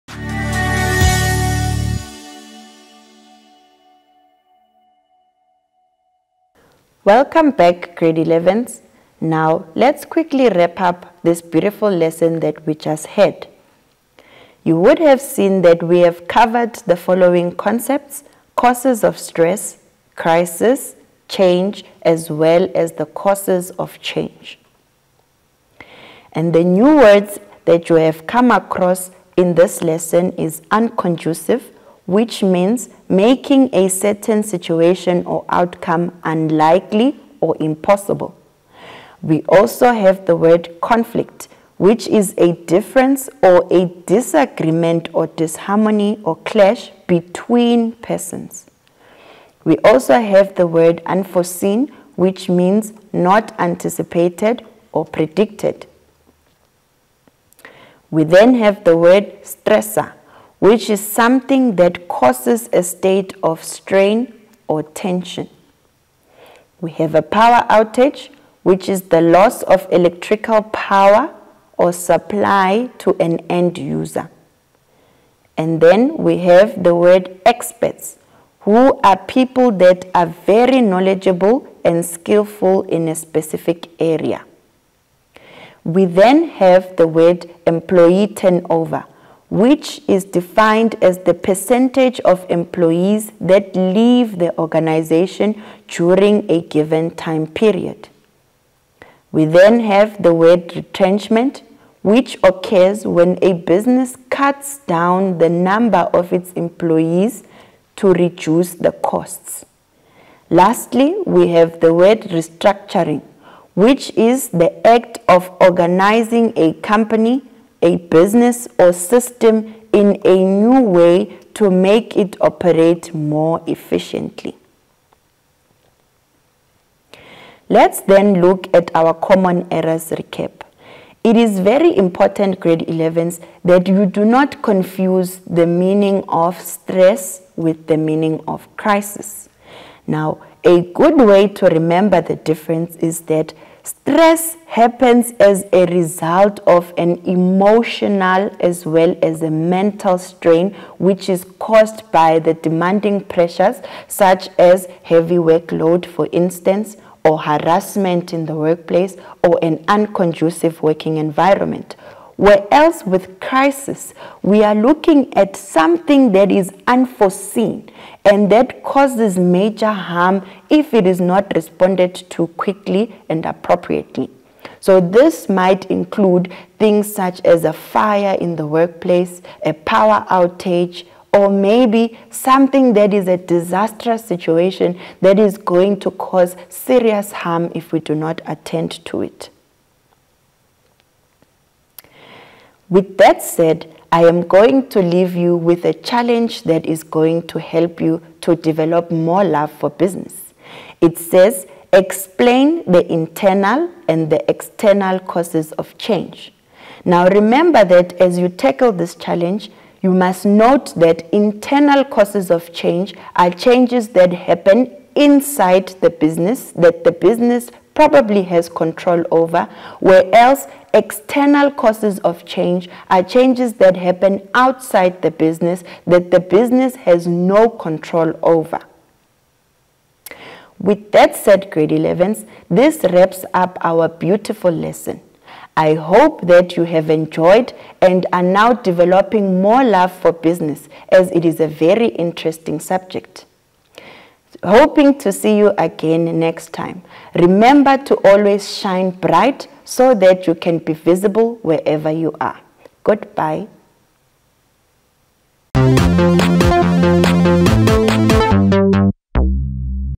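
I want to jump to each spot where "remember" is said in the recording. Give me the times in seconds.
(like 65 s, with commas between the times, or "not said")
141 s, 207 s, 247 s.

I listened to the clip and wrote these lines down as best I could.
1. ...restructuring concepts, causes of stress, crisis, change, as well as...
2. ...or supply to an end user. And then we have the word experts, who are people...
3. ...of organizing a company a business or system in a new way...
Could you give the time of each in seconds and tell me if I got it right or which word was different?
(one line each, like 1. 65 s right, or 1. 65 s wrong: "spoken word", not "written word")
1. 16 s wrong: "following", not "restructuring"
2. 71 s right
3. 115 s right.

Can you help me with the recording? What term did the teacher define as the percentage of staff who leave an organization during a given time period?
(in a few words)
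Employee turnover.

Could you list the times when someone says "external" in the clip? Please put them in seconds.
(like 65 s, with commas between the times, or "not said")
204 s, 220 s.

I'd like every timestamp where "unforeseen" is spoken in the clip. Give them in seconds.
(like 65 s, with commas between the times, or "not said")
51 s, 166 s.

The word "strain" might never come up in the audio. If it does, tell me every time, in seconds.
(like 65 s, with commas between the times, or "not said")
63 s, 150 s.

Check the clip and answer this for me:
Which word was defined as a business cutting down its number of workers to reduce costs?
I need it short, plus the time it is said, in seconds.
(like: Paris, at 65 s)
Retrenchment, at 100 s.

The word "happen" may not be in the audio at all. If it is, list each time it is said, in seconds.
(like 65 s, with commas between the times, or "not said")
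144 s, 214 s, 223 s.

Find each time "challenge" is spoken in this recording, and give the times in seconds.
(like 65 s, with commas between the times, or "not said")
195 s, 209 s.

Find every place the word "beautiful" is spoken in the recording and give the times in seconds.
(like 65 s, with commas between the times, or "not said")
11 s, 234 s.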